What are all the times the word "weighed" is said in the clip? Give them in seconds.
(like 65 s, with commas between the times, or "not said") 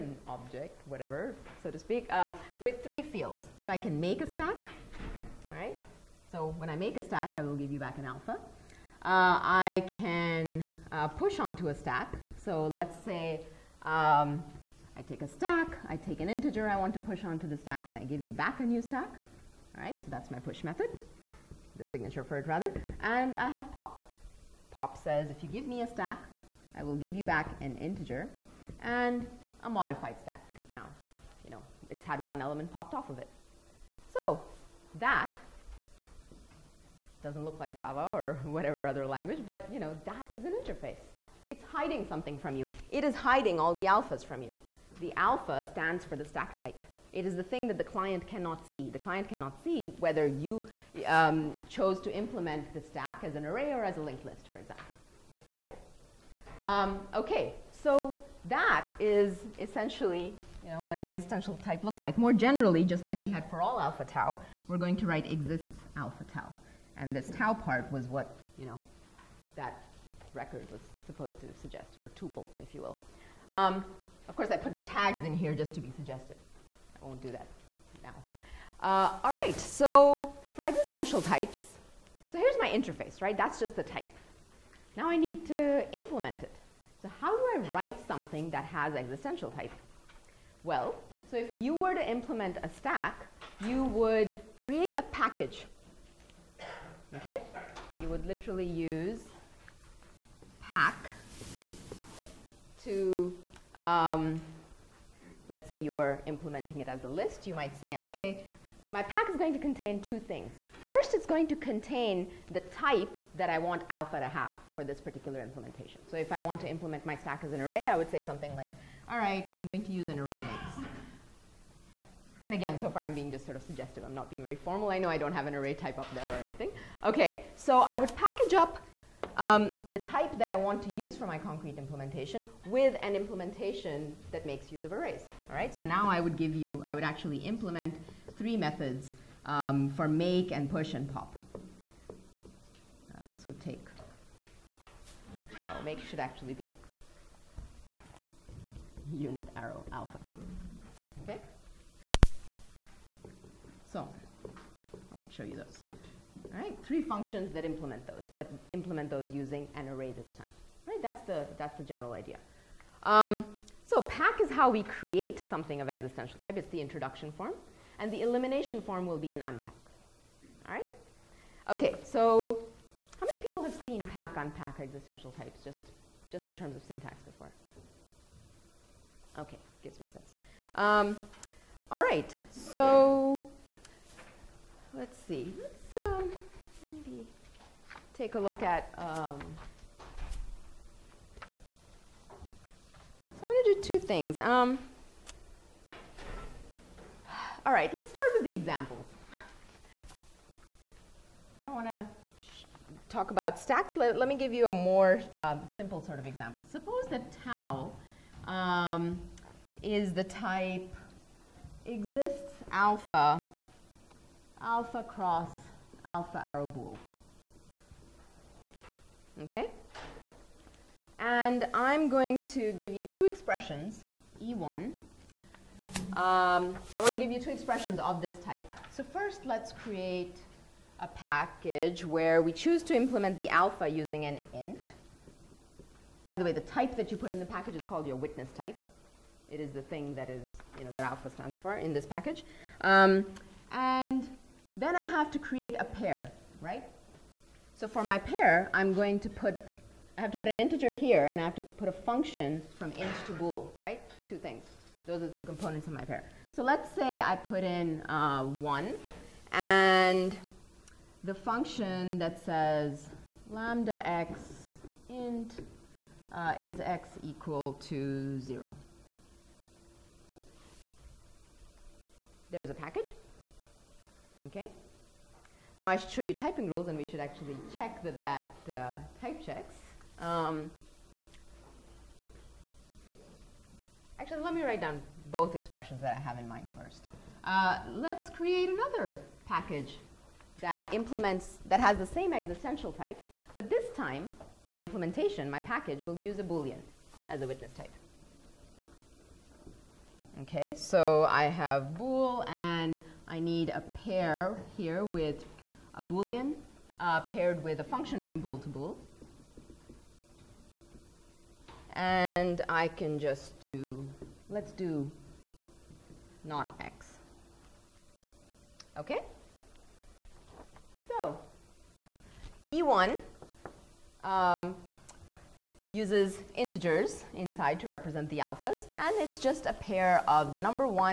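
not said.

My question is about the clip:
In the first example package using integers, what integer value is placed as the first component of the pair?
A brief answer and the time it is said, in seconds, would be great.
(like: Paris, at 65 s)
1, at 258 s.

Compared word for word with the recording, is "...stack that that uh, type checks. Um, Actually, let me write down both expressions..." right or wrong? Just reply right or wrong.
wrong.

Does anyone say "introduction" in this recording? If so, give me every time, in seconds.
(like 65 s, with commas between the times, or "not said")
166 s.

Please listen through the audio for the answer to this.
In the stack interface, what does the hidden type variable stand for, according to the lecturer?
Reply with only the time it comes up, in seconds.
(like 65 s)
46 s.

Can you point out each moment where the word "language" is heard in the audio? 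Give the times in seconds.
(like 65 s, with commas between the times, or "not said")
39 s.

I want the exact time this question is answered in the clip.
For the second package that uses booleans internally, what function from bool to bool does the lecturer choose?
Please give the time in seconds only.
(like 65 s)
316 s.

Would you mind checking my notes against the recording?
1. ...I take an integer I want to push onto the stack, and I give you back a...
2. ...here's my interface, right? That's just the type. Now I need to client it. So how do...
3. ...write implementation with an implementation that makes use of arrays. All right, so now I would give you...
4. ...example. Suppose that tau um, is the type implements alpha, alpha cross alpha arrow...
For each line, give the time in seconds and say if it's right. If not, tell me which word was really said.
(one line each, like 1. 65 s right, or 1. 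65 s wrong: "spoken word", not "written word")
1. 15 s right
2. 82 s wrong: "implement", not "client"
3. 131 s wrong: "concrete", not "write"
4. 206 s wrong: "exists", not "implements".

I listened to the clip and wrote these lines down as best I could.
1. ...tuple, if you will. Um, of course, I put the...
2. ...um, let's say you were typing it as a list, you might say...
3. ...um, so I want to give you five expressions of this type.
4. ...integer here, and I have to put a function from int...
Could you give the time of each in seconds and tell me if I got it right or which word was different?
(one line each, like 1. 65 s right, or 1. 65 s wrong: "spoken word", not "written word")
1. 72 s right
2. 103 s wrong: "implementing", not "typing"
3. 226 s wrong: "two", not "five"
4. 250 s right.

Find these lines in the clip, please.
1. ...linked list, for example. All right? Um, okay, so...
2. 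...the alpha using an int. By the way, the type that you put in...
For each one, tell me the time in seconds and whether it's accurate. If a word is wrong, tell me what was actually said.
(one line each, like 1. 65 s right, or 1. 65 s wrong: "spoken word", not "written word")
1. 54 s right
2. 233 s right.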